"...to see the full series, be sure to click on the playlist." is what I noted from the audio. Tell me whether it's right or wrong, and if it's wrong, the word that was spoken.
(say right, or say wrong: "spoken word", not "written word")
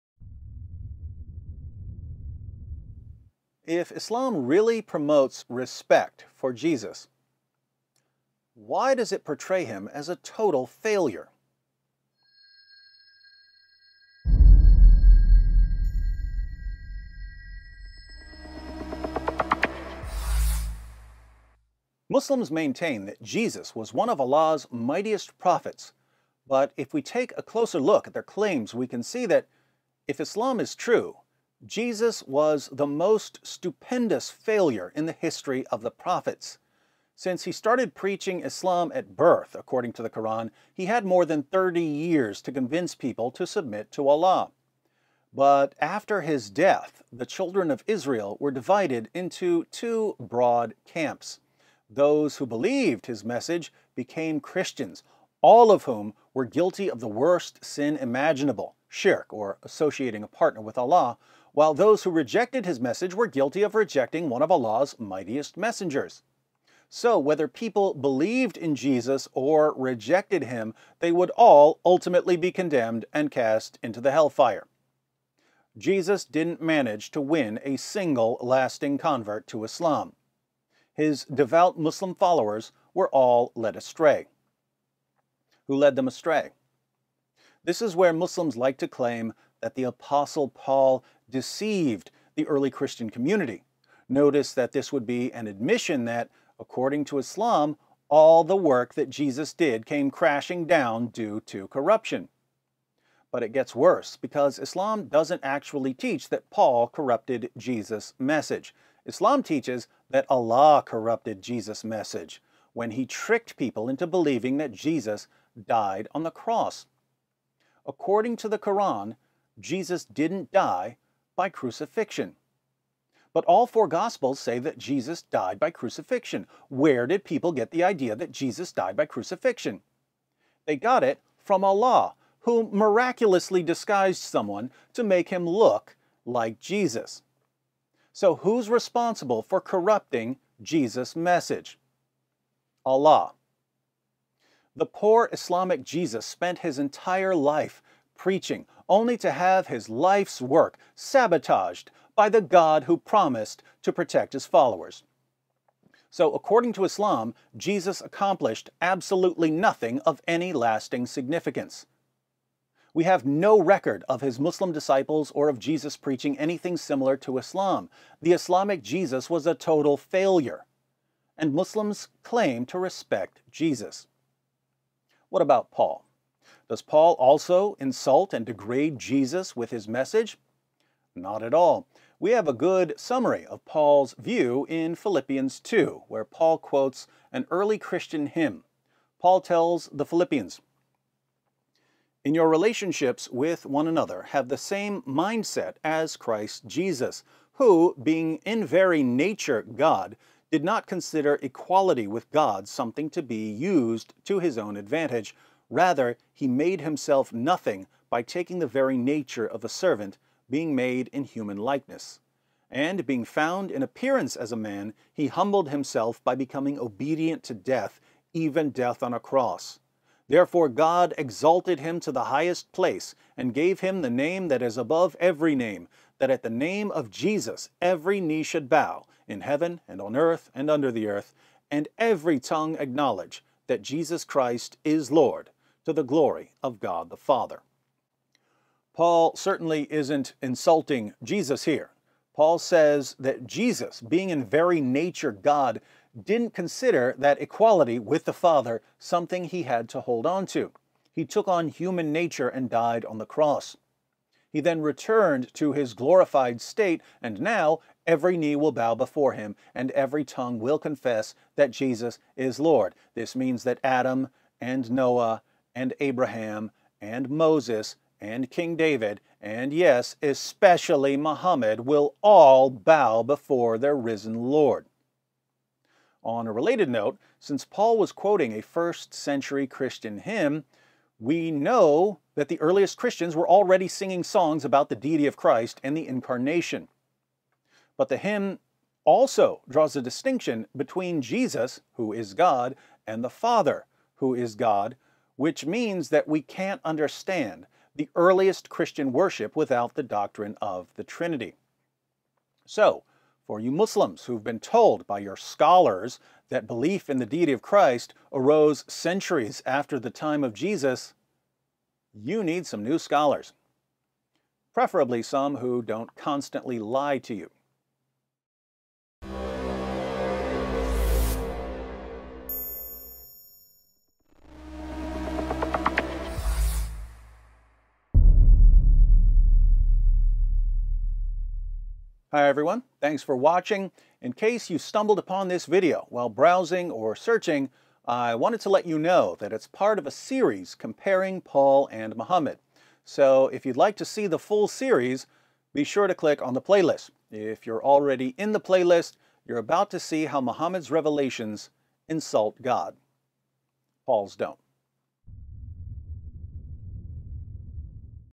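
right.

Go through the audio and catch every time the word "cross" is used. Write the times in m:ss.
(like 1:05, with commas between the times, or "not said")
1:56, 3:39, 4:13.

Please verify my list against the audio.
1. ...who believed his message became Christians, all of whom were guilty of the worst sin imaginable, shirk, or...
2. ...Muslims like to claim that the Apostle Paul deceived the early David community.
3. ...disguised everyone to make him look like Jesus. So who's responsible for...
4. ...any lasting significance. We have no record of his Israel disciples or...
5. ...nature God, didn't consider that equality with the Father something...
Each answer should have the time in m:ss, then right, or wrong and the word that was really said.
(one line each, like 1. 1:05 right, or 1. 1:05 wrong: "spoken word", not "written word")
1. 0:52 right
2. 1:28 wrong: "Christian", not "David"
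3. 2:13 wrong: "someone", not "everyone"
4. 2:40 wrong: "Muslim", not "Israel"
5. 4:04 right.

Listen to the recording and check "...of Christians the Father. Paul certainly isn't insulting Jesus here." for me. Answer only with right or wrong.
wrong.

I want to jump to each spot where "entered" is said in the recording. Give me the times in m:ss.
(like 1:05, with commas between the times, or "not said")
not said.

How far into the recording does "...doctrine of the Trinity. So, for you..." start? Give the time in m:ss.
5:00.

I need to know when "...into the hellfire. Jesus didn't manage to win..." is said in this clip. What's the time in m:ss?
1:13.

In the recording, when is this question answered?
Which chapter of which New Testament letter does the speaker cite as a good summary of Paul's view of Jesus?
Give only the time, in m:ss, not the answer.
3:04.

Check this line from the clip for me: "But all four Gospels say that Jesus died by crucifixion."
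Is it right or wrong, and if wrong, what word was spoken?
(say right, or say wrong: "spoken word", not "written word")
right.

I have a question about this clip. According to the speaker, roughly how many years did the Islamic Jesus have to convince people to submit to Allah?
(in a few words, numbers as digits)
More than 30.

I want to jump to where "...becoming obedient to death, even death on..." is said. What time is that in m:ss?
3:36.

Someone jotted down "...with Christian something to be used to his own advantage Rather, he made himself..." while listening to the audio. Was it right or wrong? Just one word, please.
wrong.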